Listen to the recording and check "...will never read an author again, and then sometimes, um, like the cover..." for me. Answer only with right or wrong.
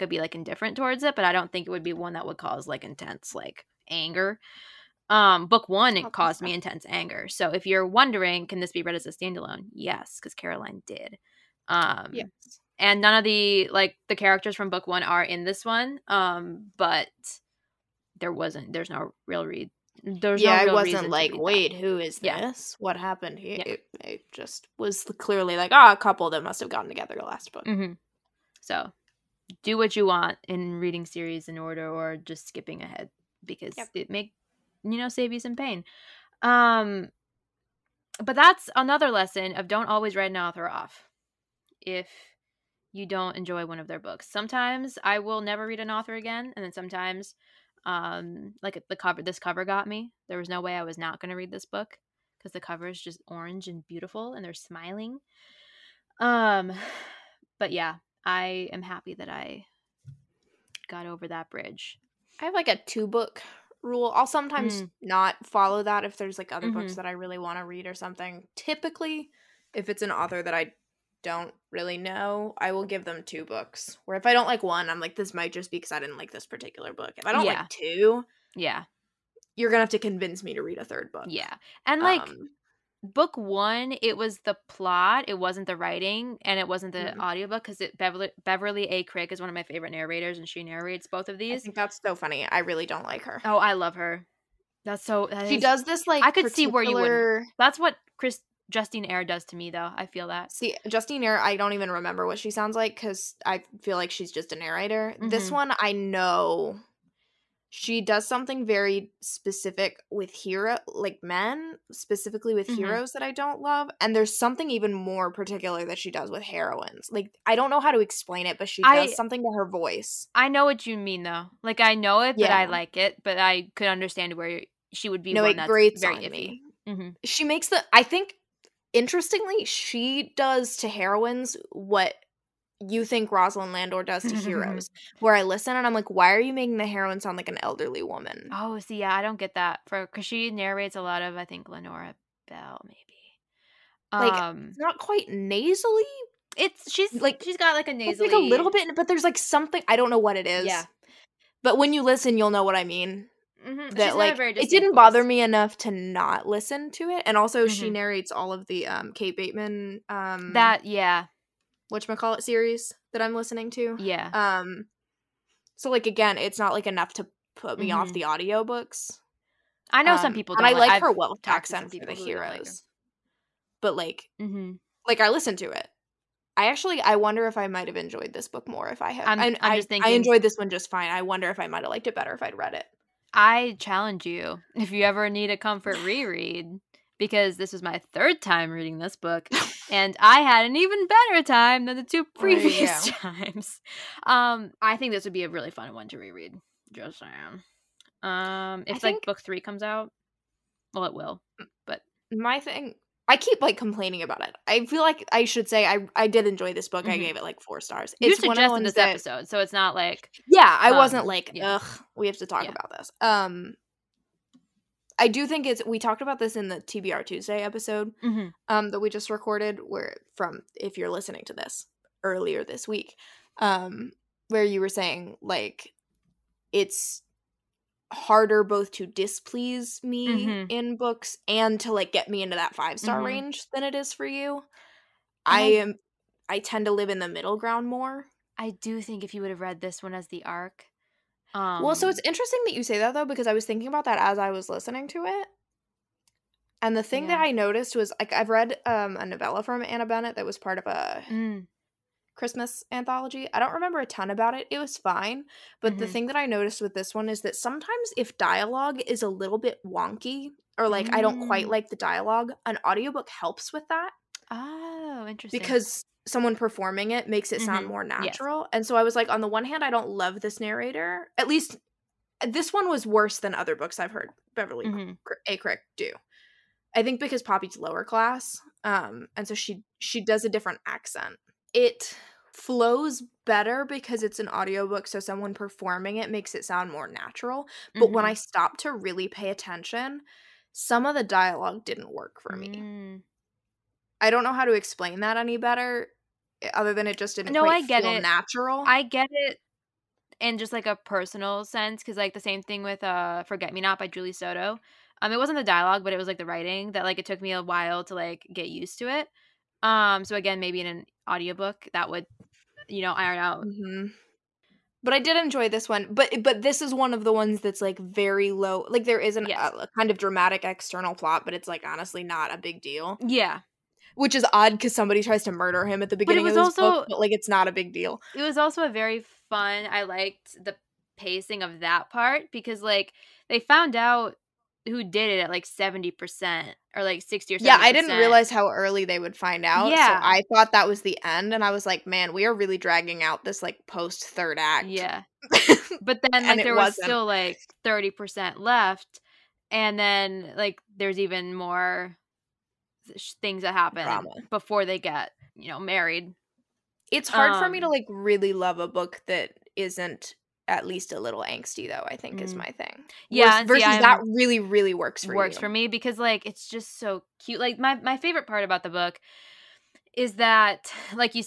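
right.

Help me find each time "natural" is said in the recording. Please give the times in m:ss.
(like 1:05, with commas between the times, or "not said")
4:28, 4:47, 4:58.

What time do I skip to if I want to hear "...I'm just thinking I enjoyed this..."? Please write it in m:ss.
2:59.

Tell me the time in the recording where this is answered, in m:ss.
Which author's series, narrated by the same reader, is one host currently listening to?
2:39.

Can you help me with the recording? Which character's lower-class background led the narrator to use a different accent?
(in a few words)
Poppy.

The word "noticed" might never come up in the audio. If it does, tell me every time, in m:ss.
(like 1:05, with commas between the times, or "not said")
4:07, 4:16.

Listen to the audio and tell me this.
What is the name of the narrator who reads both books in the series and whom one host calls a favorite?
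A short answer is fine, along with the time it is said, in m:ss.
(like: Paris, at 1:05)
Beverly A. Crick, at 1:28.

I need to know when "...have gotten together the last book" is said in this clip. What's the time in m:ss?
0:26.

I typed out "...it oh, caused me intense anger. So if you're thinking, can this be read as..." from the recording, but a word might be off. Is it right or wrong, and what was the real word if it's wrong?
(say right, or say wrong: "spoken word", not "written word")
wrong: "wondering", not "thinking".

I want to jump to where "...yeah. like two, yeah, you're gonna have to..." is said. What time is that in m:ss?
1:17.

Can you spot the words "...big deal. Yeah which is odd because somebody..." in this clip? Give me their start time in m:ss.
5:22.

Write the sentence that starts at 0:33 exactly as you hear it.
it make you know, save you some pain.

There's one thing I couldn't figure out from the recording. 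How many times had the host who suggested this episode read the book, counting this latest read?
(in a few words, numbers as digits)
3.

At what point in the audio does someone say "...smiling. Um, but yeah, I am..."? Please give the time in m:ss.
0:54.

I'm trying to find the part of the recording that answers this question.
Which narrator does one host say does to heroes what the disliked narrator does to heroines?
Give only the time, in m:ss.
2:13.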